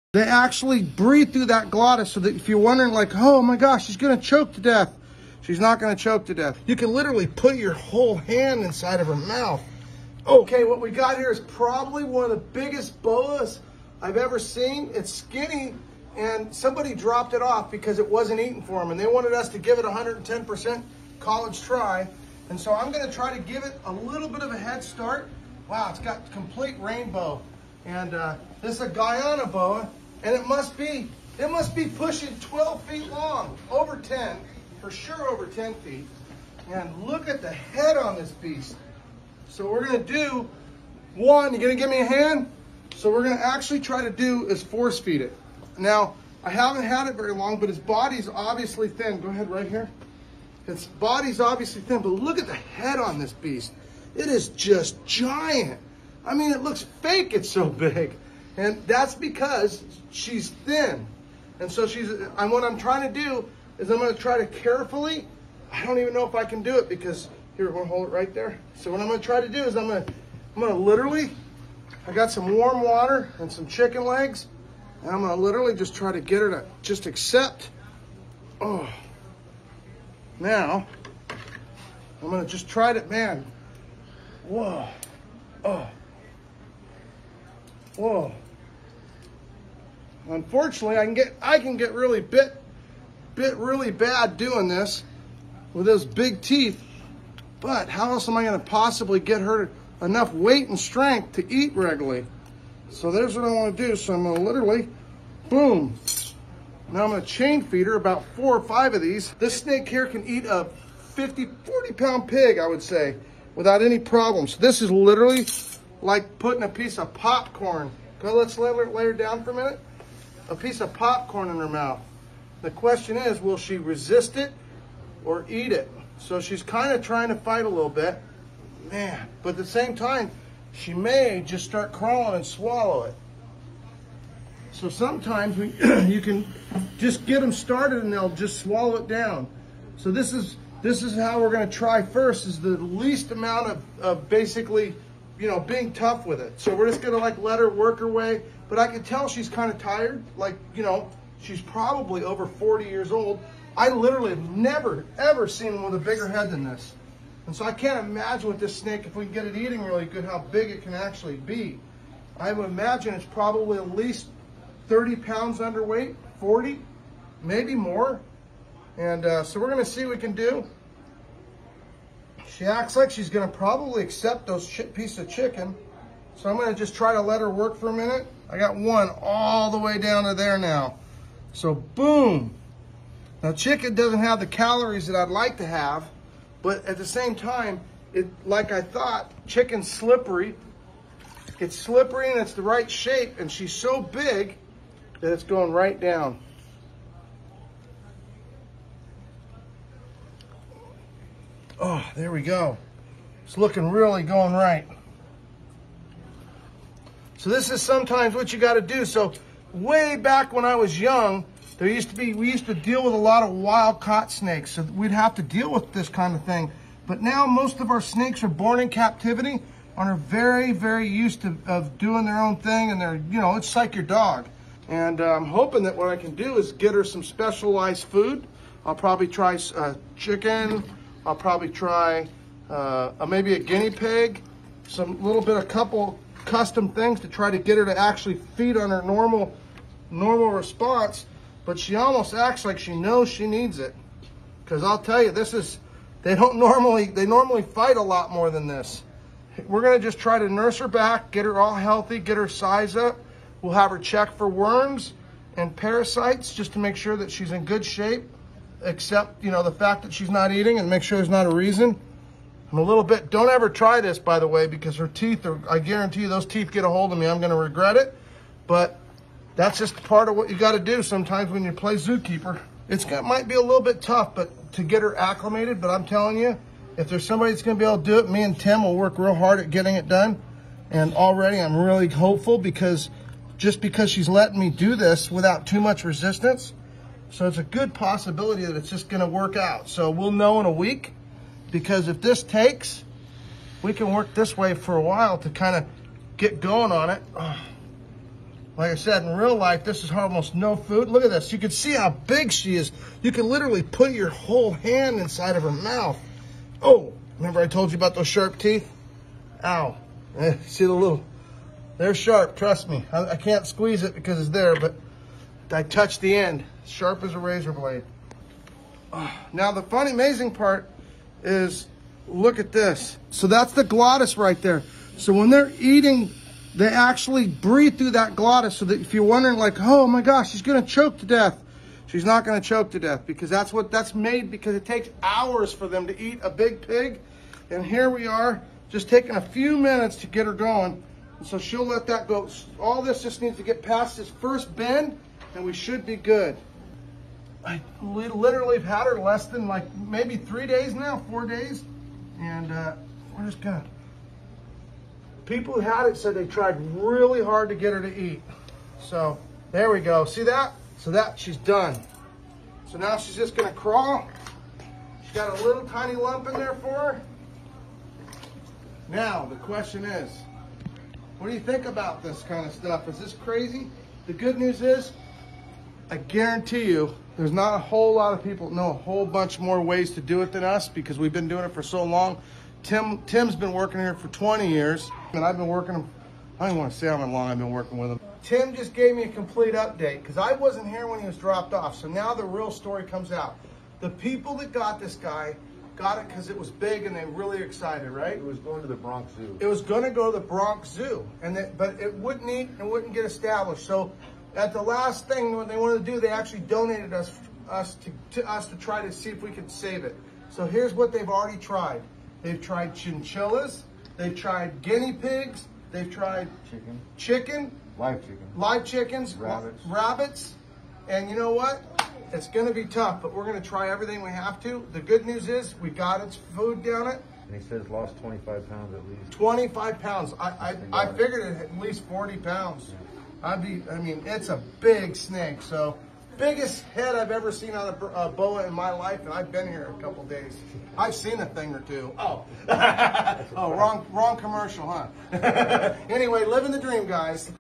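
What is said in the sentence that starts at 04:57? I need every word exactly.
Like I said, in real life, this is almost no food.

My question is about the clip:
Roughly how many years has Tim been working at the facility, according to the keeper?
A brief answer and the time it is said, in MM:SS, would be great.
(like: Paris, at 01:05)
20 years, at 06:24.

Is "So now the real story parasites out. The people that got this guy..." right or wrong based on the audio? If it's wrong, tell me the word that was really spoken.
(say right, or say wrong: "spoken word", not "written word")
wrong: "comes", not "parasites".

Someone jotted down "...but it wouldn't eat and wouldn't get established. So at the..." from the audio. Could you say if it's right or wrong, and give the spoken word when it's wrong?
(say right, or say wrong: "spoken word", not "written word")
right.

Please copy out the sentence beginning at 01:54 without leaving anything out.
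This is literally like putting a piece of popcorn.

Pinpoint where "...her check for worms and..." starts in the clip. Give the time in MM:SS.
04:13.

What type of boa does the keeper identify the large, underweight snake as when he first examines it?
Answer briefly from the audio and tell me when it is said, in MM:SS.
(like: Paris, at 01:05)
Guyana boa, at 00:28.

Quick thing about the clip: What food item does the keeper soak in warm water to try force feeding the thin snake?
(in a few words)
Chicken legs.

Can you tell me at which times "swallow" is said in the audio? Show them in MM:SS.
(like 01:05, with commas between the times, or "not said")
02:12, 02:18.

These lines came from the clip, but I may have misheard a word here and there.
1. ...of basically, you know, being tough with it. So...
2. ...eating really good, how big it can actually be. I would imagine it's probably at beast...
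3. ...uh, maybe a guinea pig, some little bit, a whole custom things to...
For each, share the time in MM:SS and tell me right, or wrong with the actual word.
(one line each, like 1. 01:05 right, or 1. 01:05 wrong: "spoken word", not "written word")
1. 02:24 right
2. 02:39 wrong: "least", not "beast"
3. 03:53 wrong: "couple", not "whole".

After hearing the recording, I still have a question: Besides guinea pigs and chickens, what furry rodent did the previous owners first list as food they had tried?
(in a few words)
Chinchillas.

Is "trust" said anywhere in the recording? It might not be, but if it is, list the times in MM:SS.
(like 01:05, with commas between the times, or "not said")
05:12.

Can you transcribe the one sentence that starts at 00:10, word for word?
Okay, what we got here is probably one of the biggest boas I've ever seen.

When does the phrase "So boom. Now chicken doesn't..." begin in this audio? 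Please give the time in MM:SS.
03:01.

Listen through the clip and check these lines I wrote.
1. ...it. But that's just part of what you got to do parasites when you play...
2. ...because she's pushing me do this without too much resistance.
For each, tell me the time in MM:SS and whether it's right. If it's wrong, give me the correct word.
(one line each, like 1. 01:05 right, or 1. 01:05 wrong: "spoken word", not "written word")
1. 04:27 wrong: "sometimes", not "parasites"
2. 04:43 wrong: "letting", not "pushing".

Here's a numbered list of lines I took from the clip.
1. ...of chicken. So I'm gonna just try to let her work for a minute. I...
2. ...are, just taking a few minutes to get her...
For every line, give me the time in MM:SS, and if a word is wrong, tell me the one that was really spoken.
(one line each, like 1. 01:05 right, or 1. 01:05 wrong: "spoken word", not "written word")
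1. 02:55 right
2. 05:38 right.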